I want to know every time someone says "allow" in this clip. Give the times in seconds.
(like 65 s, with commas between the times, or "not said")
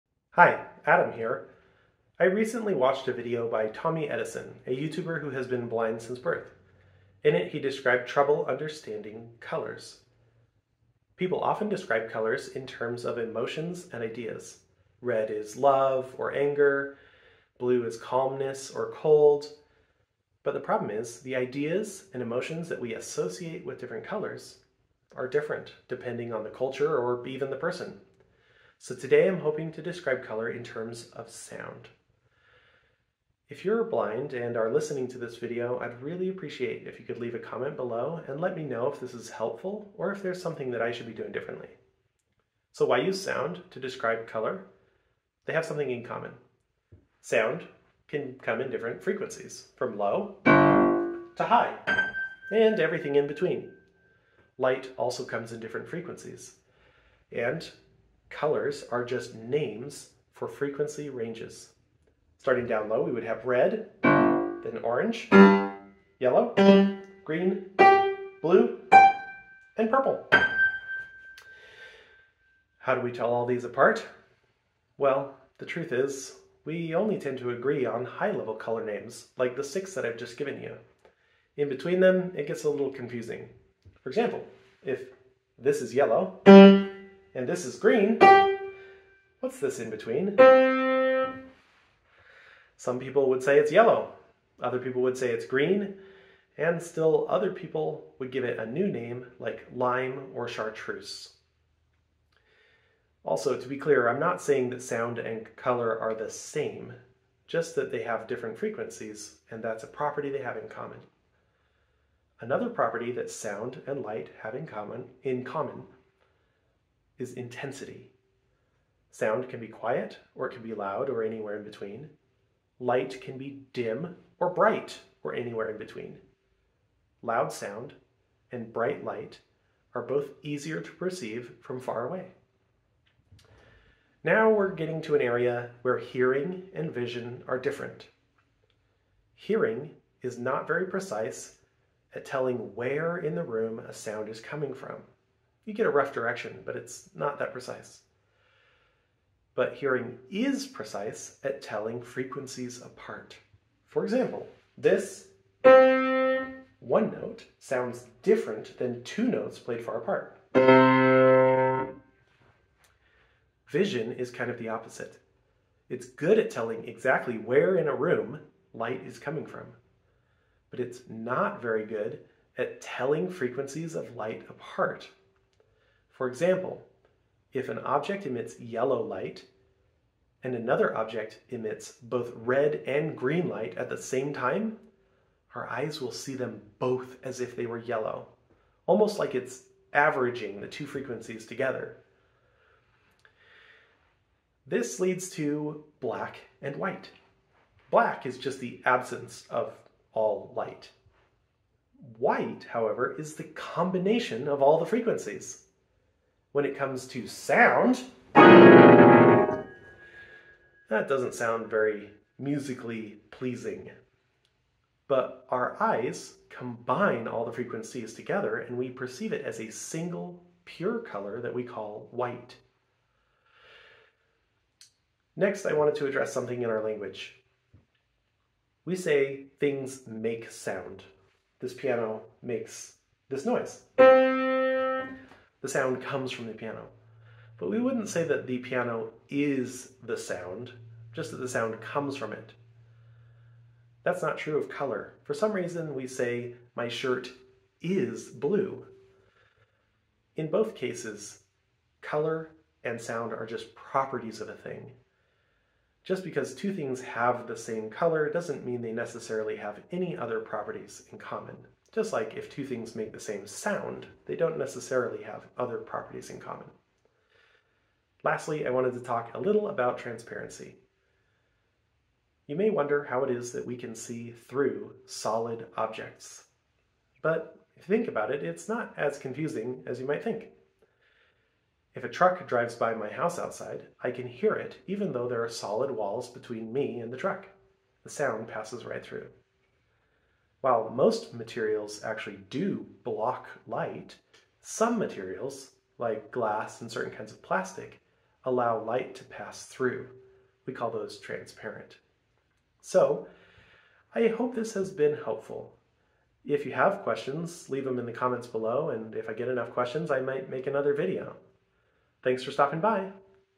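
298 s.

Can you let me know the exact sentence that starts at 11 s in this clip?
People often describe colors in terms of emotions and ideas.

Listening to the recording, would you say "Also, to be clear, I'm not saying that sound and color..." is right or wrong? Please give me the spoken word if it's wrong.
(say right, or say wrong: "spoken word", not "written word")
right.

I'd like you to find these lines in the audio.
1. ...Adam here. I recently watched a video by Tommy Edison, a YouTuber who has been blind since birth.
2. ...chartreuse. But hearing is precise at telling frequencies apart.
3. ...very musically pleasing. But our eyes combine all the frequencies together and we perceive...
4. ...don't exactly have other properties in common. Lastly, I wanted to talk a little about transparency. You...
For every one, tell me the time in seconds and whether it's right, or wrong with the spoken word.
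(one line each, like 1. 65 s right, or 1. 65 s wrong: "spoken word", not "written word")
1. 0 s right
2. 147 s wrong: "precise", not "chartreuse"
3. 211 s right
4. 264 s wrong: "necessarily", not "exactly".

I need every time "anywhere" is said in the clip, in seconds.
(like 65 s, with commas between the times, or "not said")
121 s, 125 s.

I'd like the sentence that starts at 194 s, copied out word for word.
This leads to black and white.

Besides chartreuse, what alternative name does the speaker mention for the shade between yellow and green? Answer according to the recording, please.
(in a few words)
lime.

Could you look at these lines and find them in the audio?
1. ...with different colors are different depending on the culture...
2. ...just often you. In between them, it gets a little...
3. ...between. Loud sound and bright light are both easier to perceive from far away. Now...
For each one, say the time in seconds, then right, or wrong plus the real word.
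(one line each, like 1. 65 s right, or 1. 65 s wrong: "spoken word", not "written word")
1. 23 s right
2. 80 s wrong: "given", not "often"
3. 125 s right.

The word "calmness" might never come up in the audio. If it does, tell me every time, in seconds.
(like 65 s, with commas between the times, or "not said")
17 s.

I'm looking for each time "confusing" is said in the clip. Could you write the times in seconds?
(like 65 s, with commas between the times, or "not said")
82 s, 279 s.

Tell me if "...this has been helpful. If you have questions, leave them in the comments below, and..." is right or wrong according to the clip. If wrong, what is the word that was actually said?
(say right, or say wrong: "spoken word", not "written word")
right.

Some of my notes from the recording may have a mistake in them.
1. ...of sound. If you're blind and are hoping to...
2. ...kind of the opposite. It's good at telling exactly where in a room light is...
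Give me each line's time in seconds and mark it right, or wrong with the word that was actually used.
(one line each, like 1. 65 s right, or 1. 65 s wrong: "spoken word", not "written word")
1. 31 s wrong: "listening", not "hoping"
2. 164 s right.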